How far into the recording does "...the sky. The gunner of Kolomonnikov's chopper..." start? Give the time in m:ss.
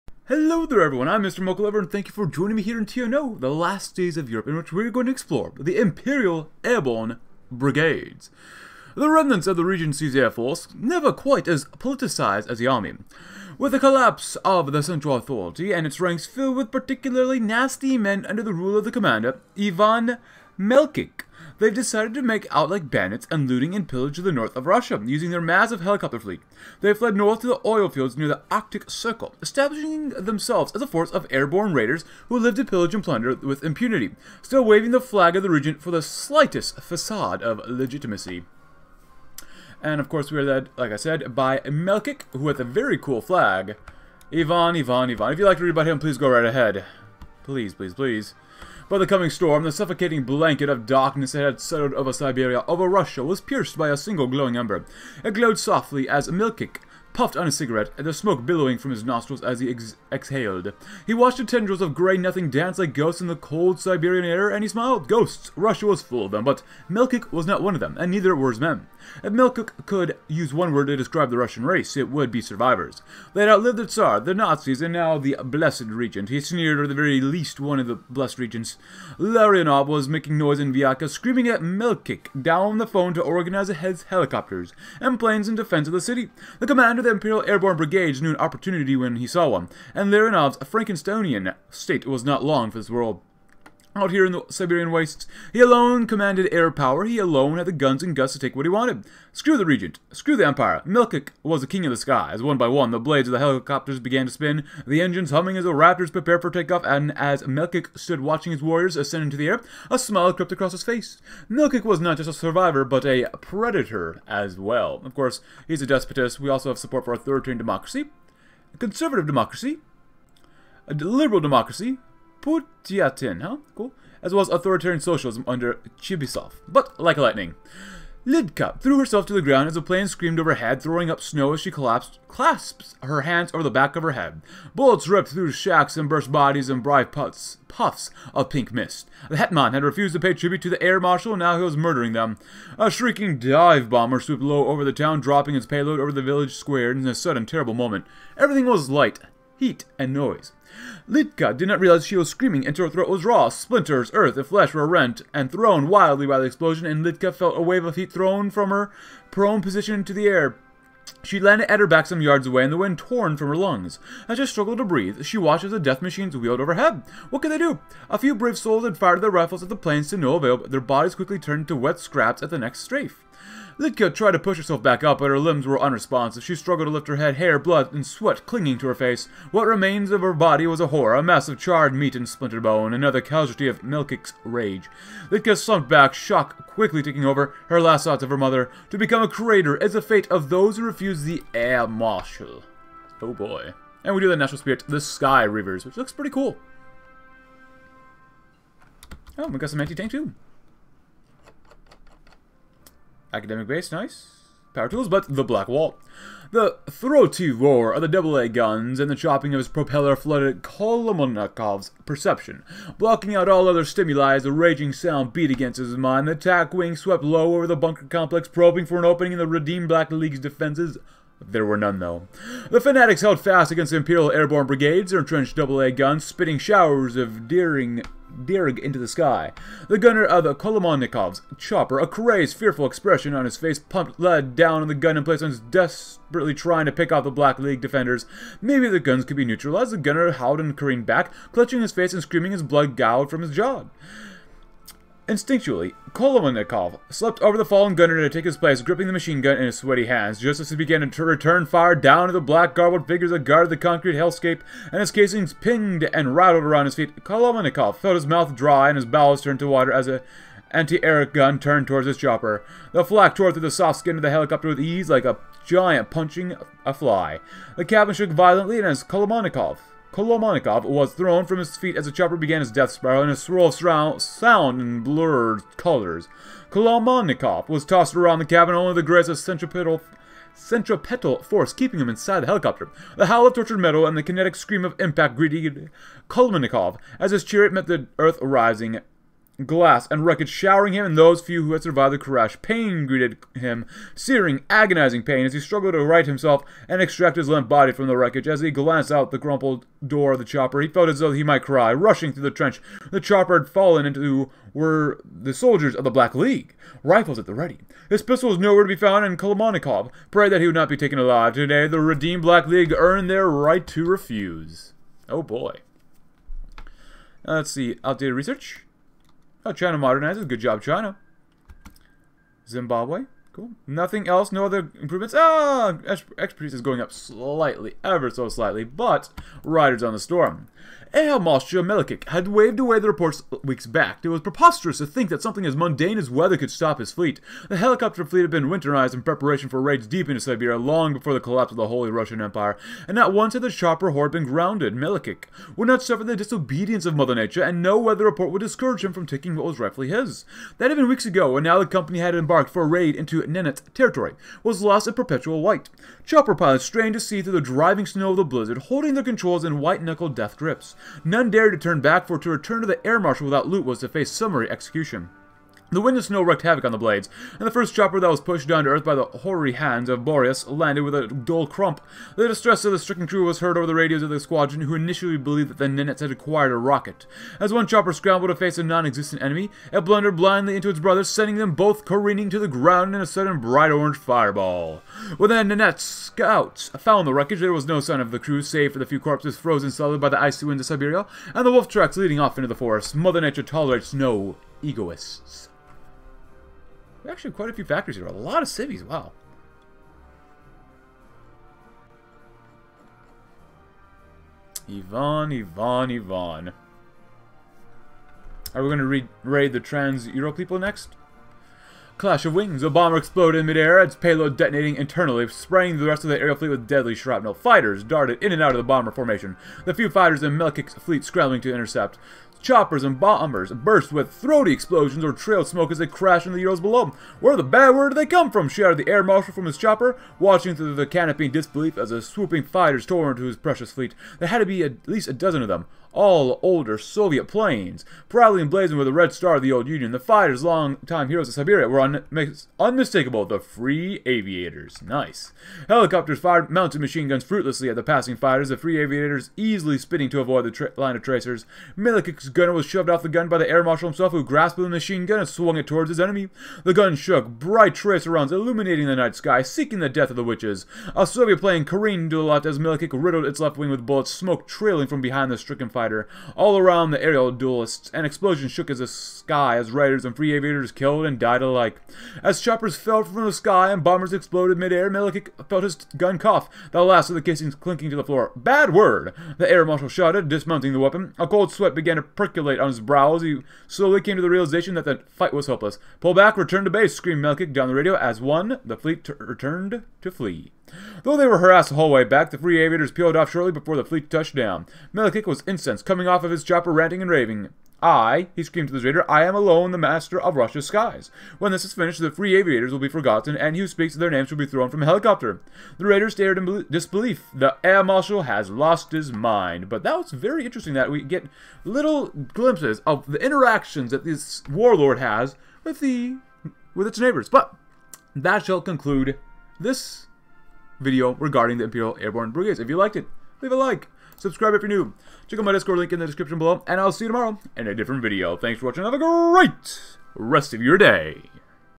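3:48.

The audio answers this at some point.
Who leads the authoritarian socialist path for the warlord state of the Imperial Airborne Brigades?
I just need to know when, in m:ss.
2:05.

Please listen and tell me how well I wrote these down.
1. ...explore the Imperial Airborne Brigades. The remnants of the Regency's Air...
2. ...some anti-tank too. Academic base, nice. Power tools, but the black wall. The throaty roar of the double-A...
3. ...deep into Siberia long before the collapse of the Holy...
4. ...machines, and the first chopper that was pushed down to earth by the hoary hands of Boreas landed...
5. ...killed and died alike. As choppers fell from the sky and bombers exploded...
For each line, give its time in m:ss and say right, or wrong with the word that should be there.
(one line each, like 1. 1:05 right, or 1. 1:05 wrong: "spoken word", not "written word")
1. 0:05 right
2. 3:19 right
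3. 5:40 right
4. 6:06 wrong: "blades", not "machines"
5. 7:50 right.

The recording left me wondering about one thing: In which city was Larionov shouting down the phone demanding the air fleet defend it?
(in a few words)
Vyatka.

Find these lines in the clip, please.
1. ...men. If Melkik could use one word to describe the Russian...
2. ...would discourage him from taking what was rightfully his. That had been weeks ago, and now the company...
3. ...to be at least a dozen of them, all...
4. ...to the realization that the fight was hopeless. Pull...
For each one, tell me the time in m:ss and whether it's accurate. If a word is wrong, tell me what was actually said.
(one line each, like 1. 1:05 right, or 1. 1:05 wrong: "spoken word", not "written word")
1. 1:08 right
2. 5:48 right
3. 7:14 right
4. 8:04 right.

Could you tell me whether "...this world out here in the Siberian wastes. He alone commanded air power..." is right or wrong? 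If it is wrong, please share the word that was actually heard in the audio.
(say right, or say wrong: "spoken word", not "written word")
right.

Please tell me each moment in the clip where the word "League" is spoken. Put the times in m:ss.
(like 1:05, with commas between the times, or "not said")
3:40, 3:57, 5:06, 5:12.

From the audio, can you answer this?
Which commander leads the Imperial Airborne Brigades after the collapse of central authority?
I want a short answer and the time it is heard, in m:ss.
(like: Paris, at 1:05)
Ivan Melkic, at 0:19.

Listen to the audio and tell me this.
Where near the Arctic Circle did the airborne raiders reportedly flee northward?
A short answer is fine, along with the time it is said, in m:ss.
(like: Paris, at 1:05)
The oil fields, at 0:27.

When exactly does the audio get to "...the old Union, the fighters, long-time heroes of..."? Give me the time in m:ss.
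7:19.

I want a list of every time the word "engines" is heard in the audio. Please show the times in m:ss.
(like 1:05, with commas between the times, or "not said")
1:45.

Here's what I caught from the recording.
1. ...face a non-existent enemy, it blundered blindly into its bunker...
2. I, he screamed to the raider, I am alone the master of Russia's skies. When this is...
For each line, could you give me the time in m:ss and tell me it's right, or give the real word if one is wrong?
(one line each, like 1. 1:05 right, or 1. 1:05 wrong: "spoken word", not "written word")
1. 6:18 wrong: "brother", not "bunker"
2. 8:18 right.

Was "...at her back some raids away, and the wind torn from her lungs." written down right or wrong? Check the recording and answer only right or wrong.
wrong.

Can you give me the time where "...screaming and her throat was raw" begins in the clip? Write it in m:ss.
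2:32.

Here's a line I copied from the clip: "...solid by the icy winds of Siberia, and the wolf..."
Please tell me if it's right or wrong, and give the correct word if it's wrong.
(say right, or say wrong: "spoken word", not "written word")
right.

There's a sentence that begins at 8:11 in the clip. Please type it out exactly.
Though they were harassed the whole way back, the free aviators peeled off shortly before the fleet touched down.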